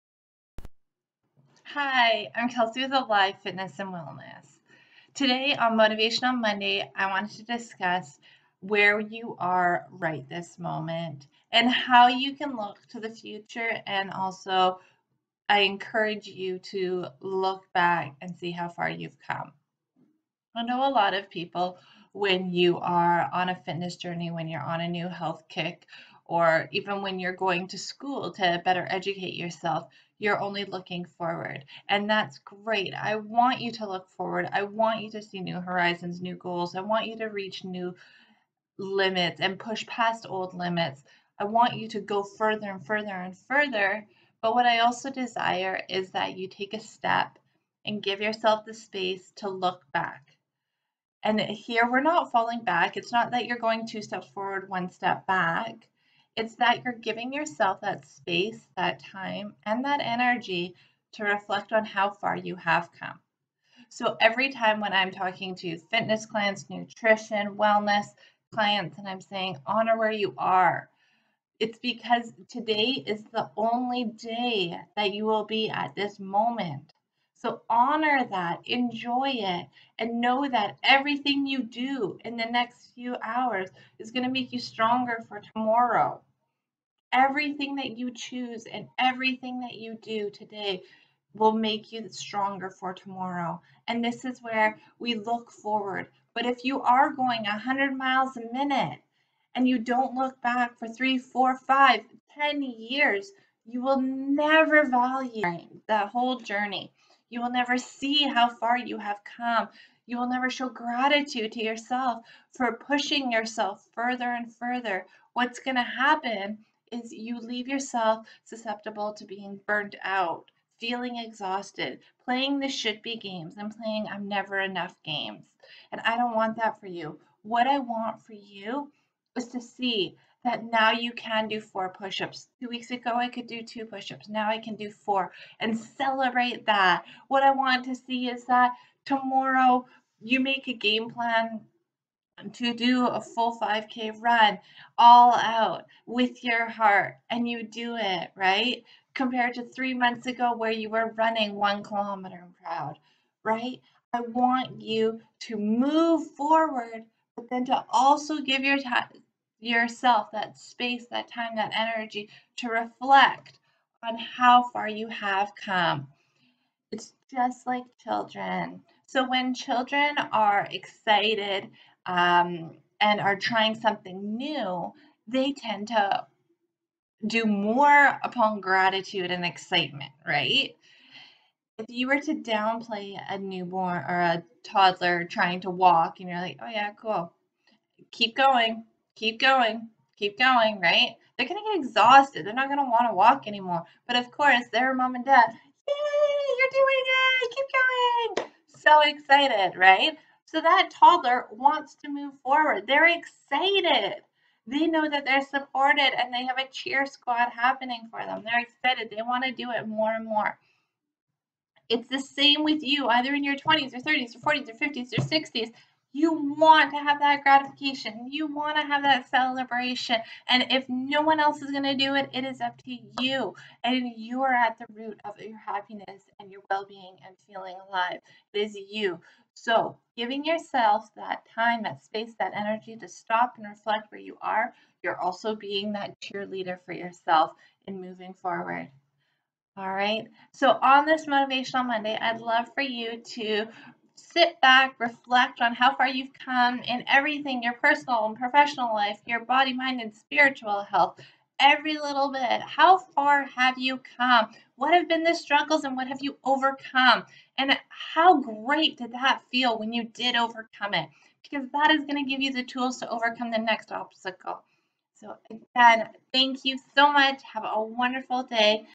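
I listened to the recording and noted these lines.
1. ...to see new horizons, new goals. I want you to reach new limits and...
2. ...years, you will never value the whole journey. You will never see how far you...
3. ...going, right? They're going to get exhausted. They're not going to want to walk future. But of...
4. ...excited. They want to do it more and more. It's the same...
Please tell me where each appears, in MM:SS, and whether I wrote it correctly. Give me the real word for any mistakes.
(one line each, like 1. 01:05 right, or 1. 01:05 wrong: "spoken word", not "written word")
1. 00:35 right
2. 01:42 right
3. 03:10 wrong: "anymore", not "future"
4. 03:28 right.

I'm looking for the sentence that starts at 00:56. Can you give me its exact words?
It's that you're giving yourself that space, that time, and that energy to reflect on how far you have come.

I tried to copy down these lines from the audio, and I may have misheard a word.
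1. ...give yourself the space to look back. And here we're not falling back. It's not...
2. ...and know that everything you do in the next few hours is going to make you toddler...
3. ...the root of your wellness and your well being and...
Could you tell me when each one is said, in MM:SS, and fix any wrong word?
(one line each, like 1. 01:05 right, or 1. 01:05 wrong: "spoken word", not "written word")
1. 00:48 right
2. 01:19 wrong: "stronger", not "toddler"
3. 03:44 wrong: "happiness", not "wellness".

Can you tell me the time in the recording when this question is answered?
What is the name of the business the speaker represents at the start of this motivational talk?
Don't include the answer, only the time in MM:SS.
00:02.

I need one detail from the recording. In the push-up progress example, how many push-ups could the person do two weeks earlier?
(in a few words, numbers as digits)
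2.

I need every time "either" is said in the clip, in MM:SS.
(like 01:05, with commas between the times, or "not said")
03:33.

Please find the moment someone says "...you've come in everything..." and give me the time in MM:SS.
04:06.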